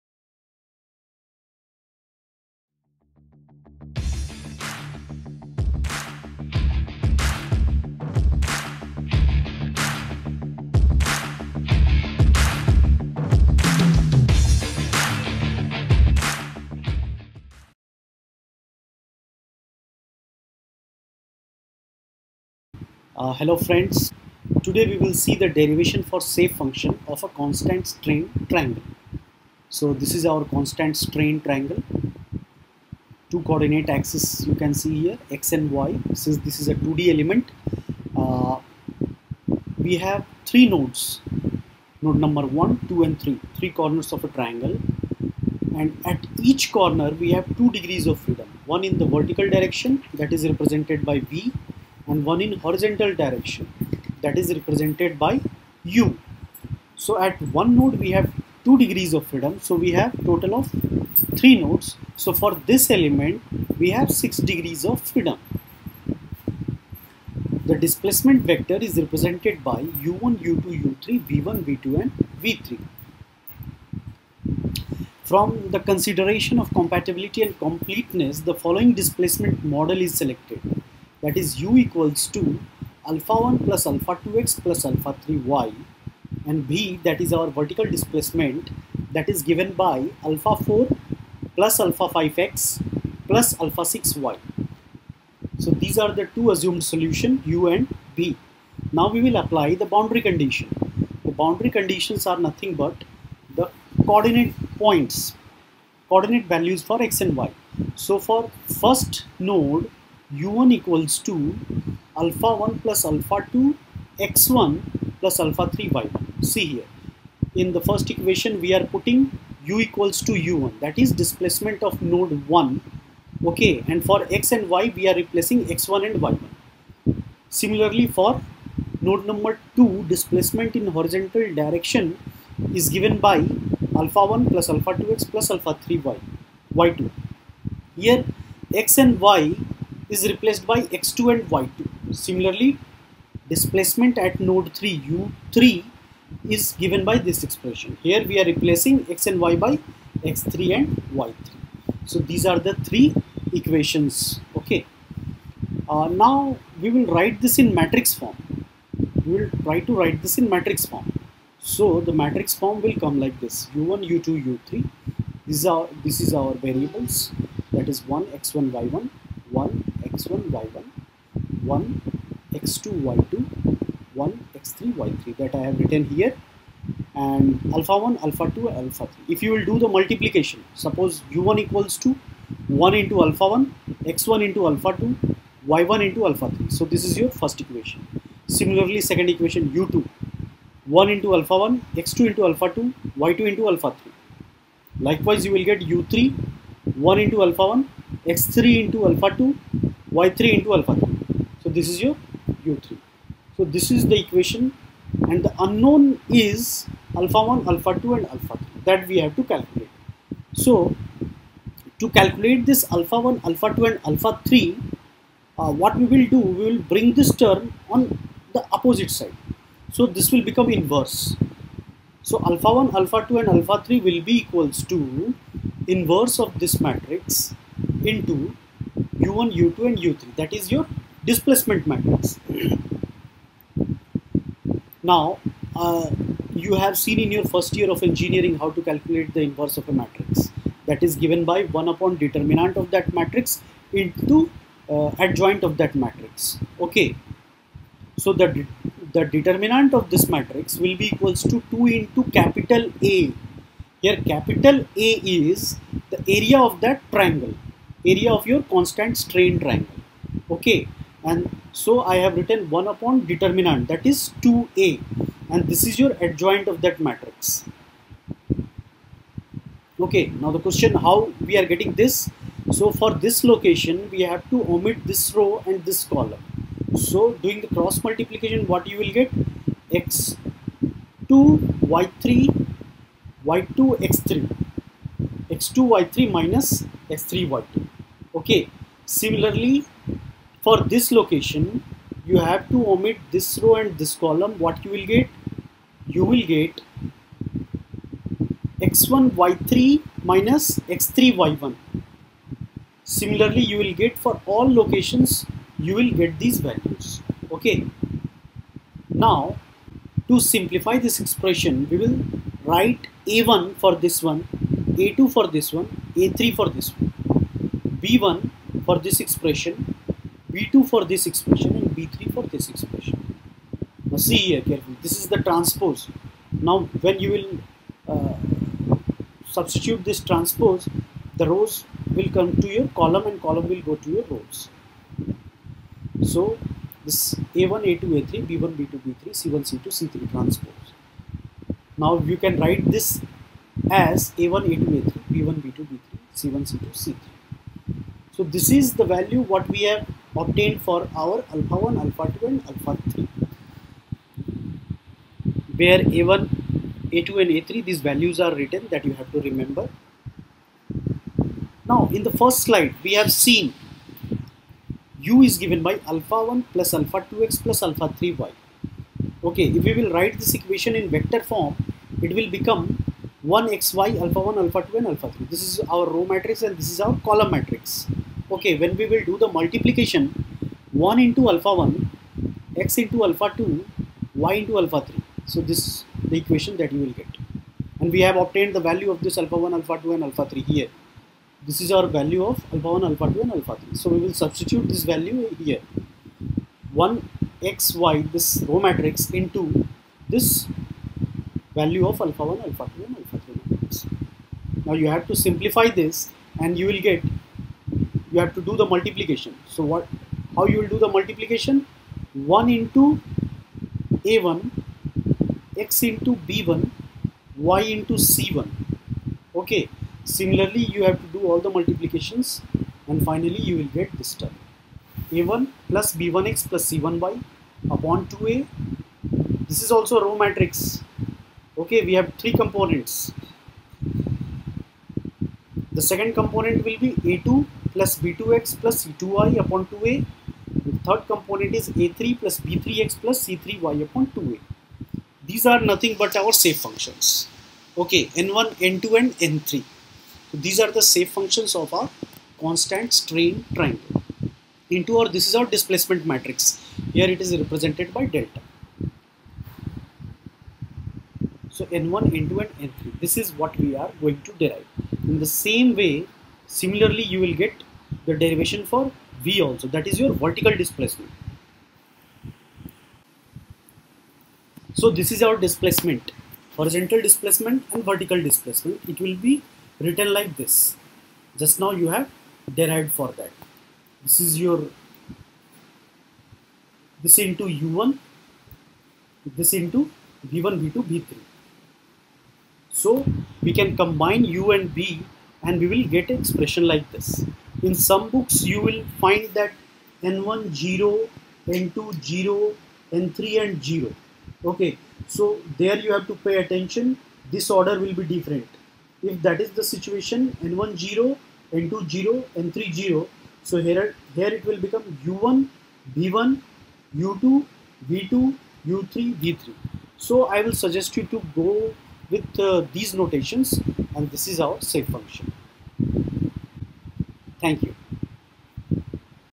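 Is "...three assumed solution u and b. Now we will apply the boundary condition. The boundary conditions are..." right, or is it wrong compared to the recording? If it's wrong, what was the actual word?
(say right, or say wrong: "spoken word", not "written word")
wrong: "two", not "three".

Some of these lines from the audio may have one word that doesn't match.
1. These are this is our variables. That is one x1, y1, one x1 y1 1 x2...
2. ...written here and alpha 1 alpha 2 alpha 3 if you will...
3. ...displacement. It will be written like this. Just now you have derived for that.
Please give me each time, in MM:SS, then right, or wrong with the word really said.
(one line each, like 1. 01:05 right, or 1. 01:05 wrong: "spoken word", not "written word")
1. 02:45 right
2. 02:55 right
3. 07:58 right.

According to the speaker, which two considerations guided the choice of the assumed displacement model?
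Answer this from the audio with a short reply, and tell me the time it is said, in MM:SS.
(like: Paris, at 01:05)
Compatibility and completeness, at 01:16.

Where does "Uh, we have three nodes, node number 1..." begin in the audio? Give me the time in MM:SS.
00:38.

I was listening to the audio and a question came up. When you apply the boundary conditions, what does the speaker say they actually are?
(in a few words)
Coordinate values for x and y.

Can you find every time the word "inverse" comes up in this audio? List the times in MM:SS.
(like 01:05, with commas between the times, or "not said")
03:40, 03:45, 03:59.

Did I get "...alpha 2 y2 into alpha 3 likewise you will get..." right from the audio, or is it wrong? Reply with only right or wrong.
right.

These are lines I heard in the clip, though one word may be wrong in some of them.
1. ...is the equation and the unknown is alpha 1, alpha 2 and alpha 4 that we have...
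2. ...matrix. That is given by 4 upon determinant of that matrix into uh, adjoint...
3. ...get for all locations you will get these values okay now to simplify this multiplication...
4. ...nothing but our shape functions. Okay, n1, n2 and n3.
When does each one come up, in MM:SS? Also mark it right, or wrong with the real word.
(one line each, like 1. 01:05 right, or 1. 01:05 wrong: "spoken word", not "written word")
1. 03:23 wrong: "3", not "4"
2. 03:59 wrong: "1", not "4"
3. 05:04 wrong: "expression", not "multiplication"
4. 07:25 right.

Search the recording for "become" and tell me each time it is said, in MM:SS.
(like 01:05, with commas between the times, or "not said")
03:40, 06:12, 08:34.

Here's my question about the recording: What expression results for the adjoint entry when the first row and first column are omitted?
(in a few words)
x2 y3 minus x3 y2.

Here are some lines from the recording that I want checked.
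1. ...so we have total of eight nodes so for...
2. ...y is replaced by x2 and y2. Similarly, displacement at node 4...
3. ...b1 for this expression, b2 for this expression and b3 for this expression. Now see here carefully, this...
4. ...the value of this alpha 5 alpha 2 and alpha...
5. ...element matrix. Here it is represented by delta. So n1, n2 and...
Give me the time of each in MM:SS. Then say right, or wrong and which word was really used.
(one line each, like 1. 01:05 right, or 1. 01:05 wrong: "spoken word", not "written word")
1. 00:59 wrong: "three", not "eight"
2. 02:19 wrong: "3", not "4"
3. 05:18 right
4. 06:28 wrong: "1", not "5"
5. 07:35 wrong: "displacement", not "element".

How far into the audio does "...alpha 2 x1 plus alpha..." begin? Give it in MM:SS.
01:53.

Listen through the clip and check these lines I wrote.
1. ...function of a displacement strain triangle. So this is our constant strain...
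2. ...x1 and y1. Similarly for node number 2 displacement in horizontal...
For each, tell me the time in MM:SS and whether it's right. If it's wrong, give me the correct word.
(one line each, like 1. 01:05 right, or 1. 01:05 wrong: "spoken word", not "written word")
1. 00:26 wrong: "constant", not "displacement"
2. 02:05 right.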